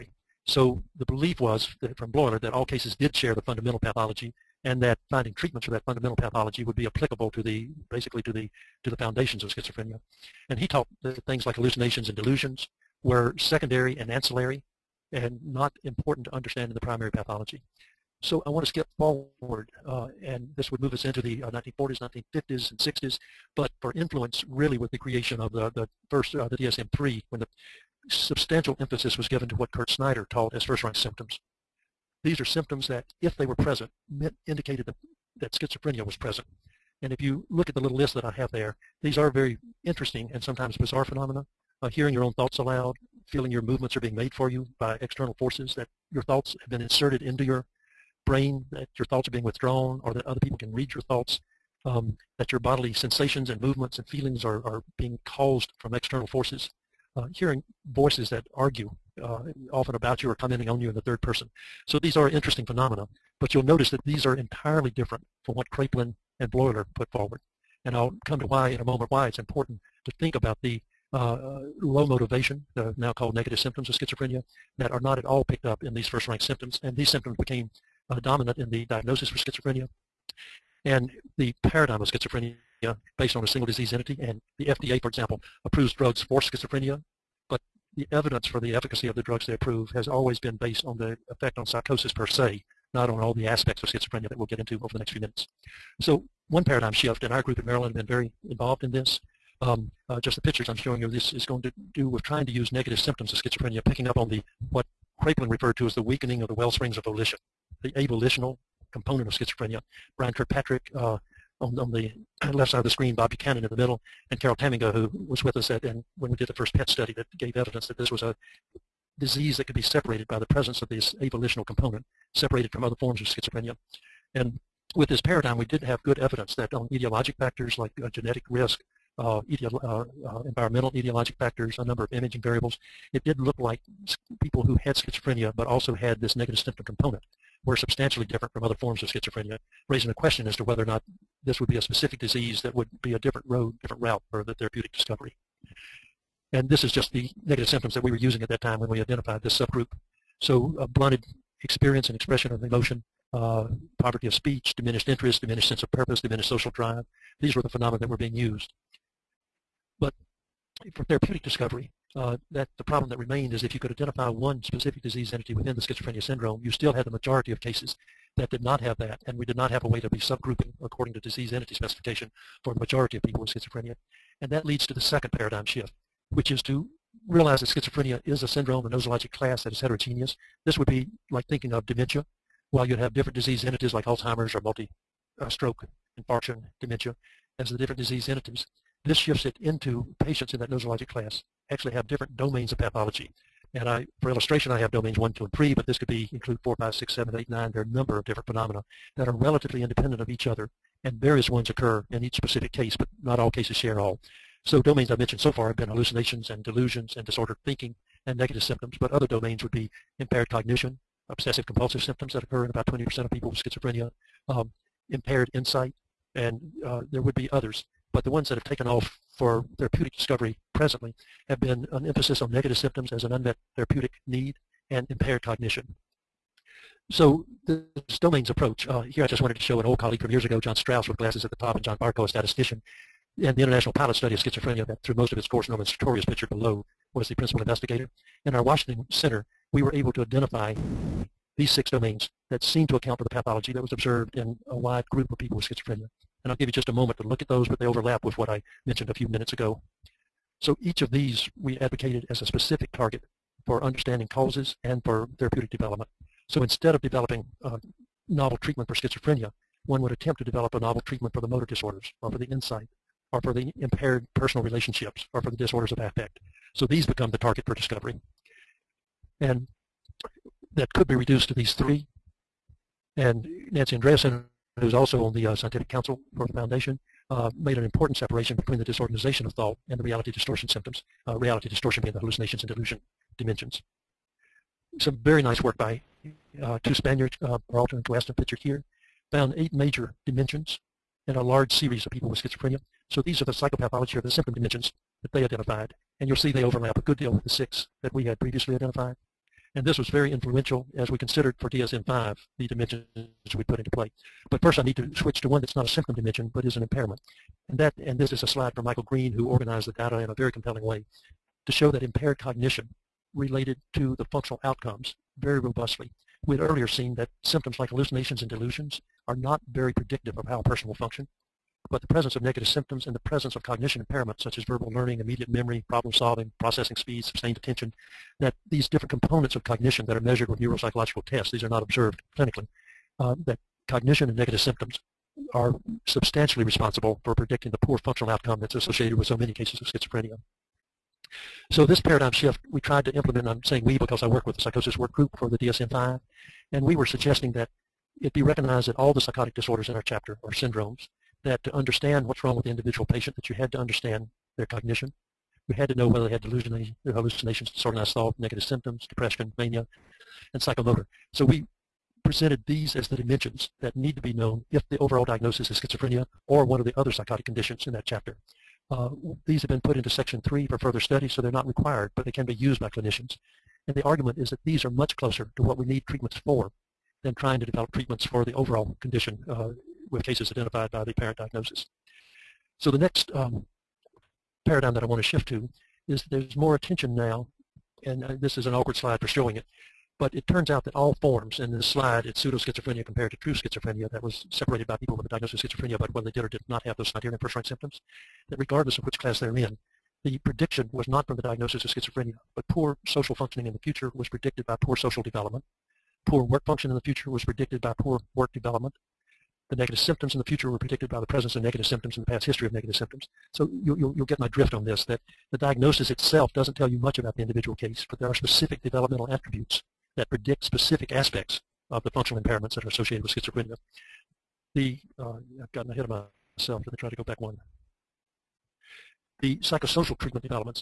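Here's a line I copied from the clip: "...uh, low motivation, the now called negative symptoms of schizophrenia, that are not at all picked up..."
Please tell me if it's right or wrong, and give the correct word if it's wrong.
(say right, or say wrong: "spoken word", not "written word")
right.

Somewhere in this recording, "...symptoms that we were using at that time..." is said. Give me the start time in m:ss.
2:27.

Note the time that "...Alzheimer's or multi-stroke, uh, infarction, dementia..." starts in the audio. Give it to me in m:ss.
3:04.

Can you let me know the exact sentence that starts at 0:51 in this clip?
Um, that your bodily sensations and movements and feelings are, are being caused from external forces.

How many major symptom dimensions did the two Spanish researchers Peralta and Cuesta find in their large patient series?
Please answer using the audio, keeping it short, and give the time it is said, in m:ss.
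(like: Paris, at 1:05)
8, at 4:49.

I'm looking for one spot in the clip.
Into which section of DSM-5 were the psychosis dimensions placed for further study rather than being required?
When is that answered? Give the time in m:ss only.
6:10.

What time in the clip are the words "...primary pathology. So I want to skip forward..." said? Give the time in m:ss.
0:16.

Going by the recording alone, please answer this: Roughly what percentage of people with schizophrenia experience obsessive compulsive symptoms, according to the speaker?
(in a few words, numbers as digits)
20%.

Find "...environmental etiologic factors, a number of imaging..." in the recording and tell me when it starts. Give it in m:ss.
2:10.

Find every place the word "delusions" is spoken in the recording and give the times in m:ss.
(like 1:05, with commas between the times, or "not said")
0:12, 3:26, 4:42, 5:18, 5:56.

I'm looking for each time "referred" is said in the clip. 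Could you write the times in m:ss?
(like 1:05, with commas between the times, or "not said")
1:45.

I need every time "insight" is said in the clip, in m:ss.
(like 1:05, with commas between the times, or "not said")
3:35, 4:22.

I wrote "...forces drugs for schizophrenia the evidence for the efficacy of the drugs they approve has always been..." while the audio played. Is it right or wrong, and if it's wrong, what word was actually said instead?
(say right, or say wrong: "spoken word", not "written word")
wrong: "approves", not "forces".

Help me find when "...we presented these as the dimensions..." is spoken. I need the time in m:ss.
6:01.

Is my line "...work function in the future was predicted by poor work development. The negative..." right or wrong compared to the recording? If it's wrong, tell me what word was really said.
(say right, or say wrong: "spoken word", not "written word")
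right.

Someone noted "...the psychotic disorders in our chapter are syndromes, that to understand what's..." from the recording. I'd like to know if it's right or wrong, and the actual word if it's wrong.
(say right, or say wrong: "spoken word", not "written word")
right.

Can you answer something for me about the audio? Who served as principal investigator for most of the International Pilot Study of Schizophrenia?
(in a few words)
Norman Sartorius.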